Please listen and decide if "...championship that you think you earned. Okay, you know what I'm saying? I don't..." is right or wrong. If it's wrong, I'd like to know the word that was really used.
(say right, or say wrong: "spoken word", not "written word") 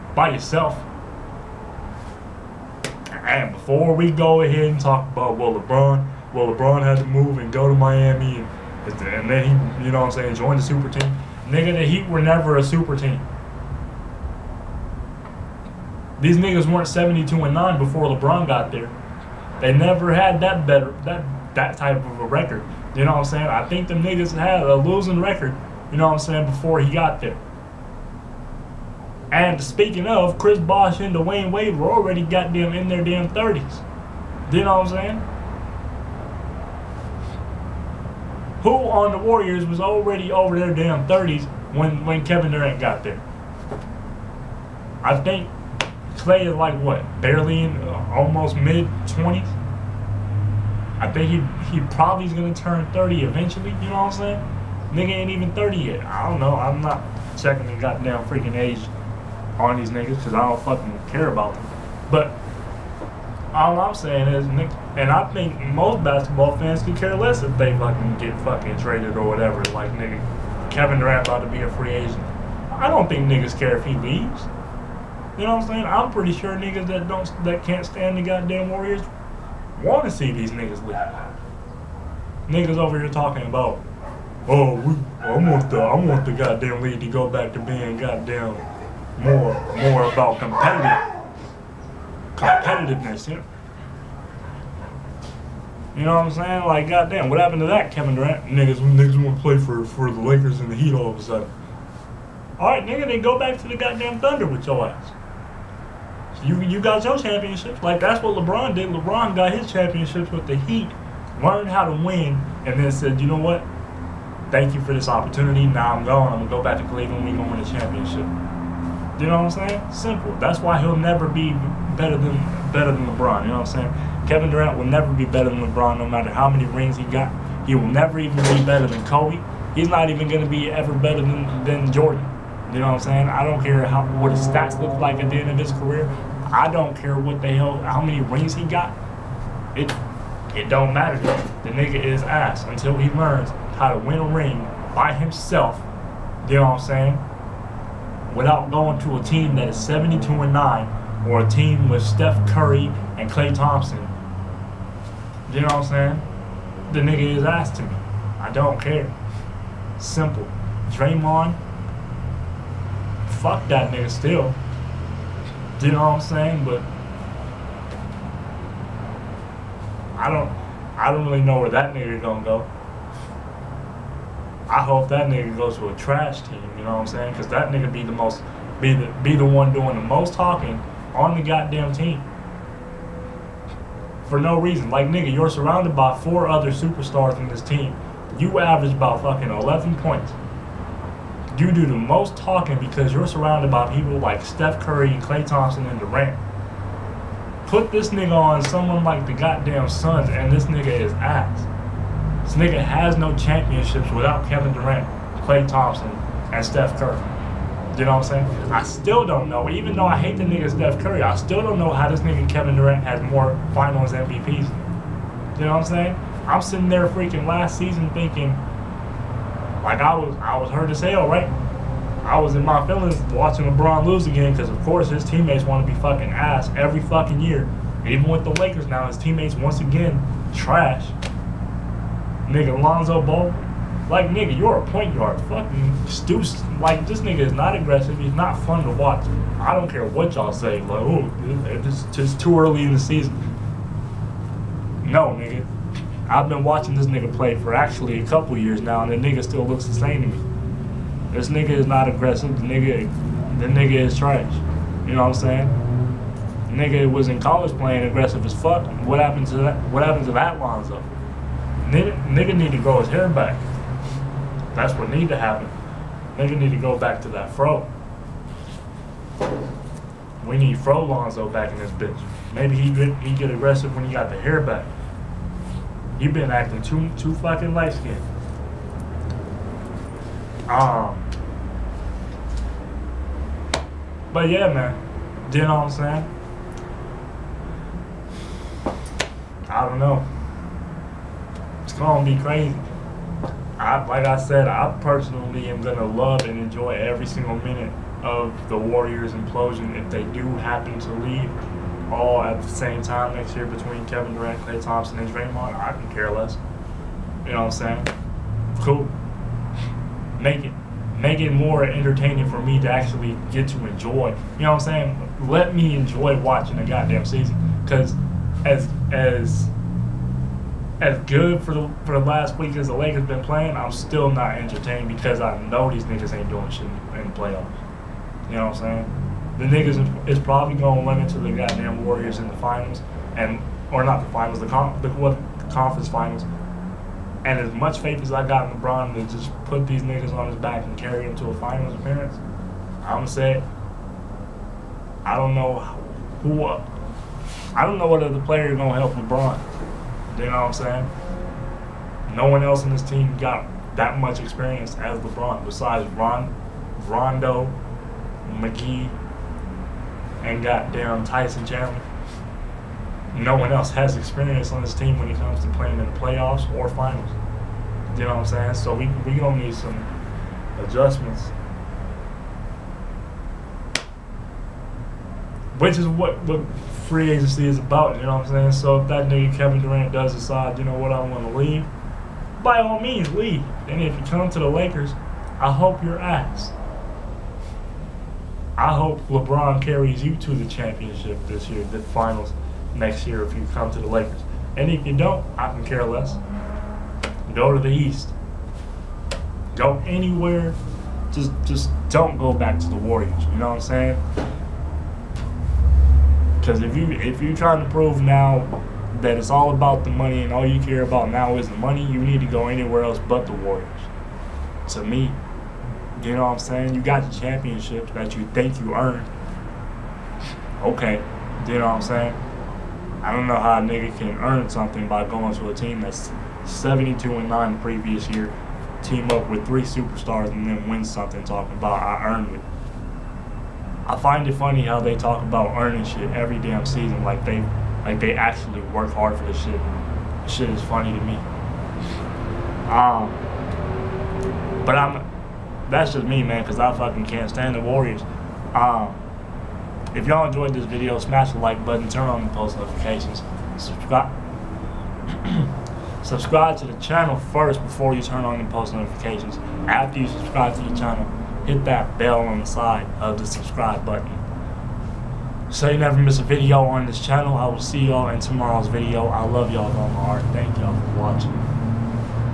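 right.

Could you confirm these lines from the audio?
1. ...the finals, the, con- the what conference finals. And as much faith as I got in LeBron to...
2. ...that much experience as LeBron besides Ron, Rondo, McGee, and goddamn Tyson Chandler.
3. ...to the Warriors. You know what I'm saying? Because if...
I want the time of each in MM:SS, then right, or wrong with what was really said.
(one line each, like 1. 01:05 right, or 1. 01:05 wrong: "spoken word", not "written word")
1. 05:34 right
2. 05:53 right
3. 06:42 right.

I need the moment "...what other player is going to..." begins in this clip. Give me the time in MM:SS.
05:48.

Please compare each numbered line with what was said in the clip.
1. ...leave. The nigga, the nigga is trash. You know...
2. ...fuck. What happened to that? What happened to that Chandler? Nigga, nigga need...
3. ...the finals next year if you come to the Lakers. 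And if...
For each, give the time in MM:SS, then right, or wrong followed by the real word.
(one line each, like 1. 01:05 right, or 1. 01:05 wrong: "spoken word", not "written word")
1. 04:12 wrong: "aggressive", not "leave"
2. 04:18 wrong: "Lonzo", not "Chandler"
3. 06:31 right.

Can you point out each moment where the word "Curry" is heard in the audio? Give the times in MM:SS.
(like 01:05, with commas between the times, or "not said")
02:32, 03:14, 03:26, 03:31.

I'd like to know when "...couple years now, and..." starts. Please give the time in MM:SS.
04:08.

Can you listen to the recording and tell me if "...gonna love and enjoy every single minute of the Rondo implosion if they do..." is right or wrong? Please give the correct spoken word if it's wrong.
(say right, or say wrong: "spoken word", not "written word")
wrong: "Warriors", not "Rondo".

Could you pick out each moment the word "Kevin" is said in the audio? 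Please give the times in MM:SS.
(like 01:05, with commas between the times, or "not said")
00:42, 01:10, 01:37, 02:04, 03:24, 03:32, 05:04, 06:19.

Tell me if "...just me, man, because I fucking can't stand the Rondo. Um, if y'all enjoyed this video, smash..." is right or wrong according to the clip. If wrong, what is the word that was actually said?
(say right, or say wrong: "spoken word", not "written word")
wrong: "Warriors", not "Rondo".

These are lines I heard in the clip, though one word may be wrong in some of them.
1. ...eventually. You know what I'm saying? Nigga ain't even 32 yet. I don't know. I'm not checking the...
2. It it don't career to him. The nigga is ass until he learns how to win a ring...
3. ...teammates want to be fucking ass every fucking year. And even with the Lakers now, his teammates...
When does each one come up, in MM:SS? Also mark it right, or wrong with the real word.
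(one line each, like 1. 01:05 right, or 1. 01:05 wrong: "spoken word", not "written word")
1. 00:53 wrong: "30", not "32"
2. 02:19 wrong: "matter", not "career"
3. 03:45 right.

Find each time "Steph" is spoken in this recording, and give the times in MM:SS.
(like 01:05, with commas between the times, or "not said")
02:32, 03:14, 03:26, 03:30.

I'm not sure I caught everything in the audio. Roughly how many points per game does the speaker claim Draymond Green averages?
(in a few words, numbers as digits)
11.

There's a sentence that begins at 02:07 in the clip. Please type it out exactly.
He will never even be better than Kobe.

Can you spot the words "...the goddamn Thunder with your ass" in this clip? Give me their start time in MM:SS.
01:43.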